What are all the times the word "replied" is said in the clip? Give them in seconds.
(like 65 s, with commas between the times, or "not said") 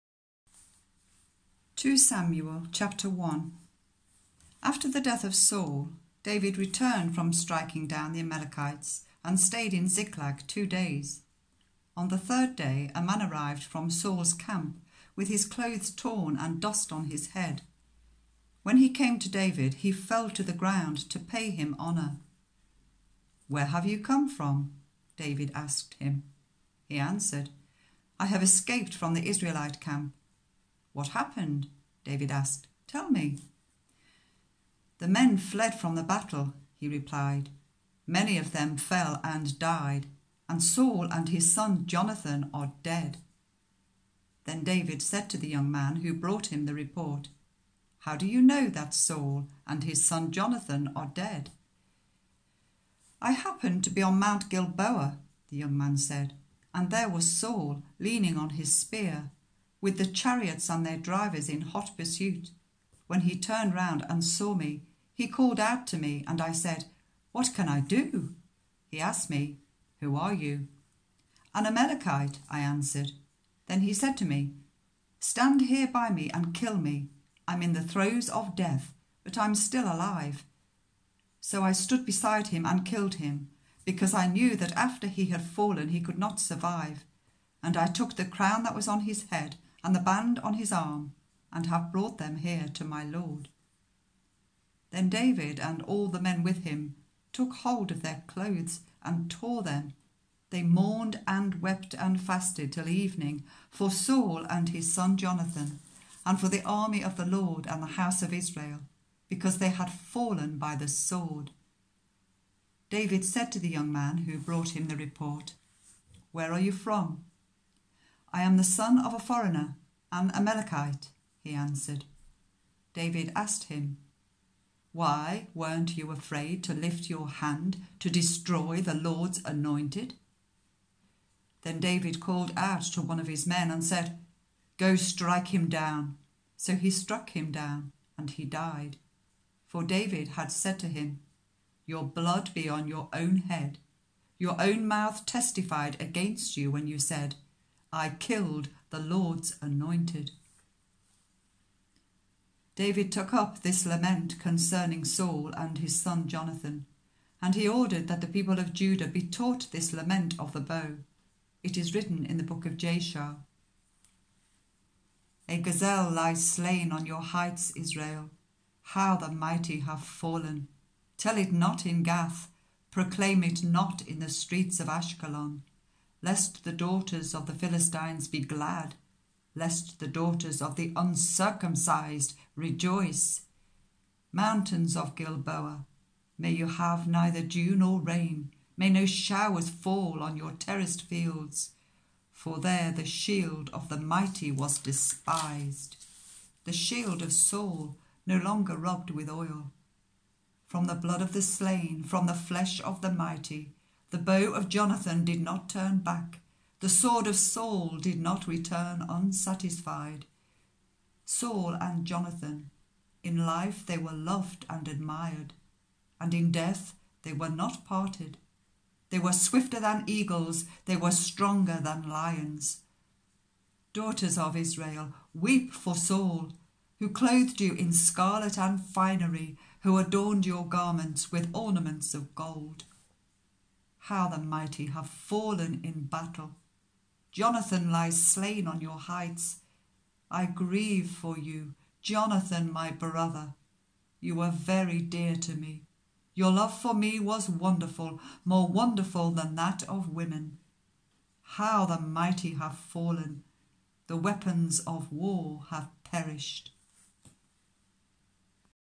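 36 s.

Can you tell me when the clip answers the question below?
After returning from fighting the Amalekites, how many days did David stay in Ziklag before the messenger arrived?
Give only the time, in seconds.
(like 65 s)
10 s.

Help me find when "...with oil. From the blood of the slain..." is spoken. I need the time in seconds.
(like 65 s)
199 s.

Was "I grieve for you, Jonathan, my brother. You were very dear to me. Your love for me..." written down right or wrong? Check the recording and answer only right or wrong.
right.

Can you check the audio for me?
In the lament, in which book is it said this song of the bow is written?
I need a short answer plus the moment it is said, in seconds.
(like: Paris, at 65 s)
The book of Jashar, at 162 s.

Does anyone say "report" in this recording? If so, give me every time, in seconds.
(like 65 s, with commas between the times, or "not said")
46 s, 114 s.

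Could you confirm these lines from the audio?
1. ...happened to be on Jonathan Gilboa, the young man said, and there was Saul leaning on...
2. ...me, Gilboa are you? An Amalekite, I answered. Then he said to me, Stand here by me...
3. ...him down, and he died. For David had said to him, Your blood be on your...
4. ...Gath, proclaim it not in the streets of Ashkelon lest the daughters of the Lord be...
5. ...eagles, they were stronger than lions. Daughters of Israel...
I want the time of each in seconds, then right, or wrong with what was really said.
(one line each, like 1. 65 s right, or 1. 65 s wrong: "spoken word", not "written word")
1. 53 s wrong: "Mount", not "Jonathan"
2. 69 s wrong: "Who", not "Gilboa"
3. 137 s right
4. 172 s wrong: "Philistines", not "Lord"
5. 220 s right.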